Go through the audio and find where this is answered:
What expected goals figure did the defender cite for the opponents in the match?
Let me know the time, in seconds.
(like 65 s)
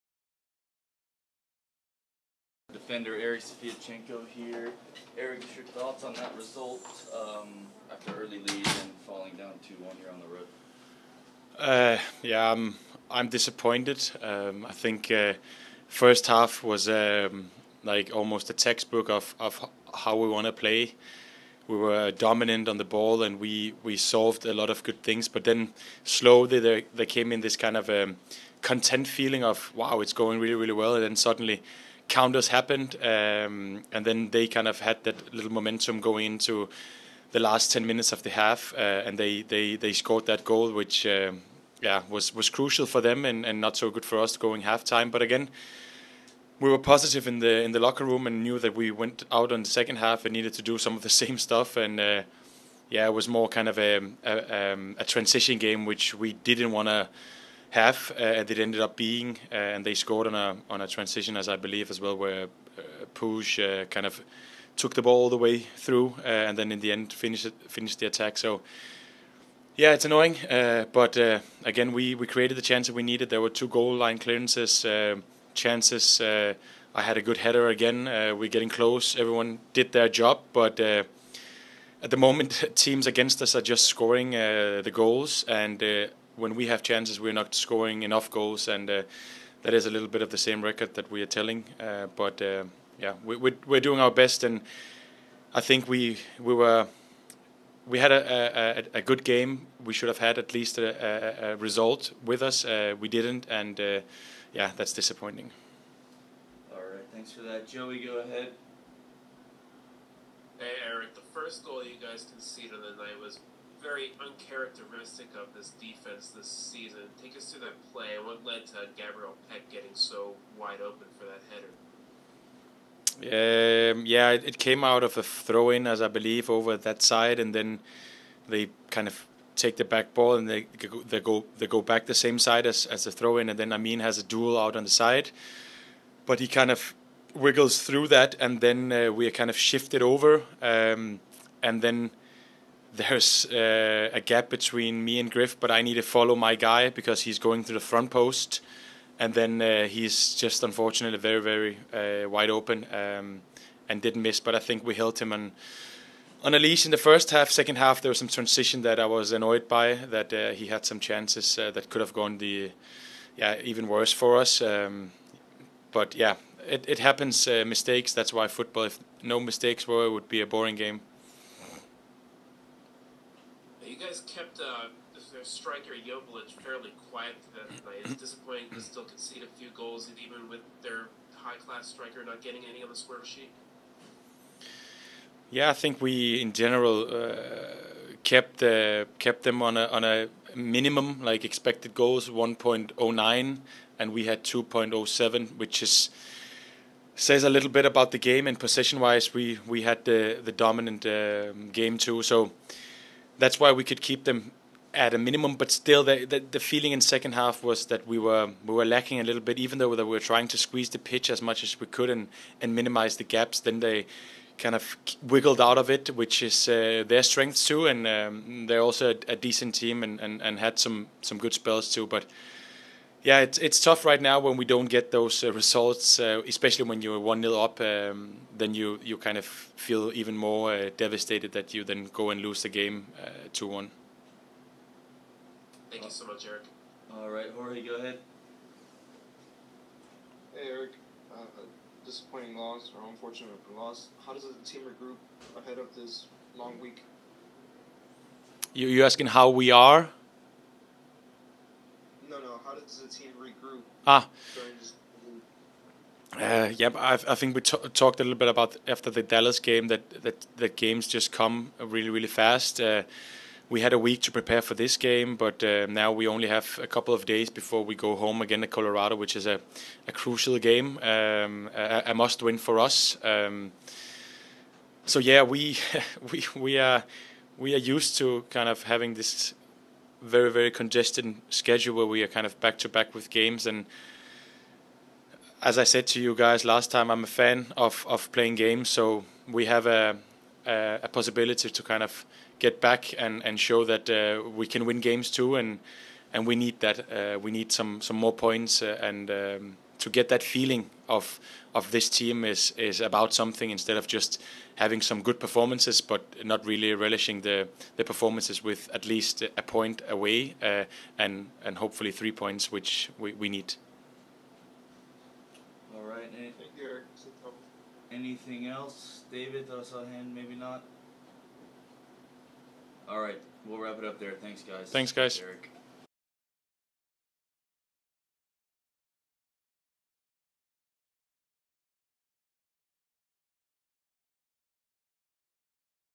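192 s.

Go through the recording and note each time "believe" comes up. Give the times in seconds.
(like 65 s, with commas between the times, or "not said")
61 s, 126 s.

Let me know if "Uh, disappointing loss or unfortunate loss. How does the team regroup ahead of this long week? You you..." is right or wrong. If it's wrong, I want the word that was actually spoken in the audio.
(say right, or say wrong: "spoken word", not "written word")
right.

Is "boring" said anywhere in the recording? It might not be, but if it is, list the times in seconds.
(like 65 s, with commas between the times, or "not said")
170 s.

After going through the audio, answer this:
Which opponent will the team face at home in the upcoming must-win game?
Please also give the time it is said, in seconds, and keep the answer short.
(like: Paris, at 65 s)
Colorado, at 268 s.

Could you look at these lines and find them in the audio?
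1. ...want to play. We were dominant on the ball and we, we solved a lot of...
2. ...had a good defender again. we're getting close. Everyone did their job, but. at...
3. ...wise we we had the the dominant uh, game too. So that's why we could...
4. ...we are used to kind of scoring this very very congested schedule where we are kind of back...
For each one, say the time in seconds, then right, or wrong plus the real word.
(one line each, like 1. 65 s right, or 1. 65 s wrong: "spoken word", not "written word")
1. 20 s right
2. 77 s wrong: "header", not "defender"
3. 198 s right
4. 277 s wrong: "having", not "scoring".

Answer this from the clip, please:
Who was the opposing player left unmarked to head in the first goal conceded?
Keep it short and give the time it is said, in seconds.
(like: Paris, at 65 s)
Gabriel Pec, at 118 s.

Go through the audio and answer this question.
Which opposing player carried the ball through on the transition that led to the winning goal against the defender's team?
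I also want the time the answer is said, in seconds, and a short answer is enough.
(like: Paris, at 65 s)
Puig, at 63 s.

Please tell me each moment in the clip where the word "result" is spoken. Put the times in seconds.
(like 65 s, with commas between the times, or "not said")
6 s, 101 s, 225 s.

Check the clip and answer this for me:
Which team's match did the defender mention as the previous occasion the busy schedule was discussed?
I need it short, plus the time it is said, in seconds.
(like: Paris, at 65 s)
Dallas, at 259 s.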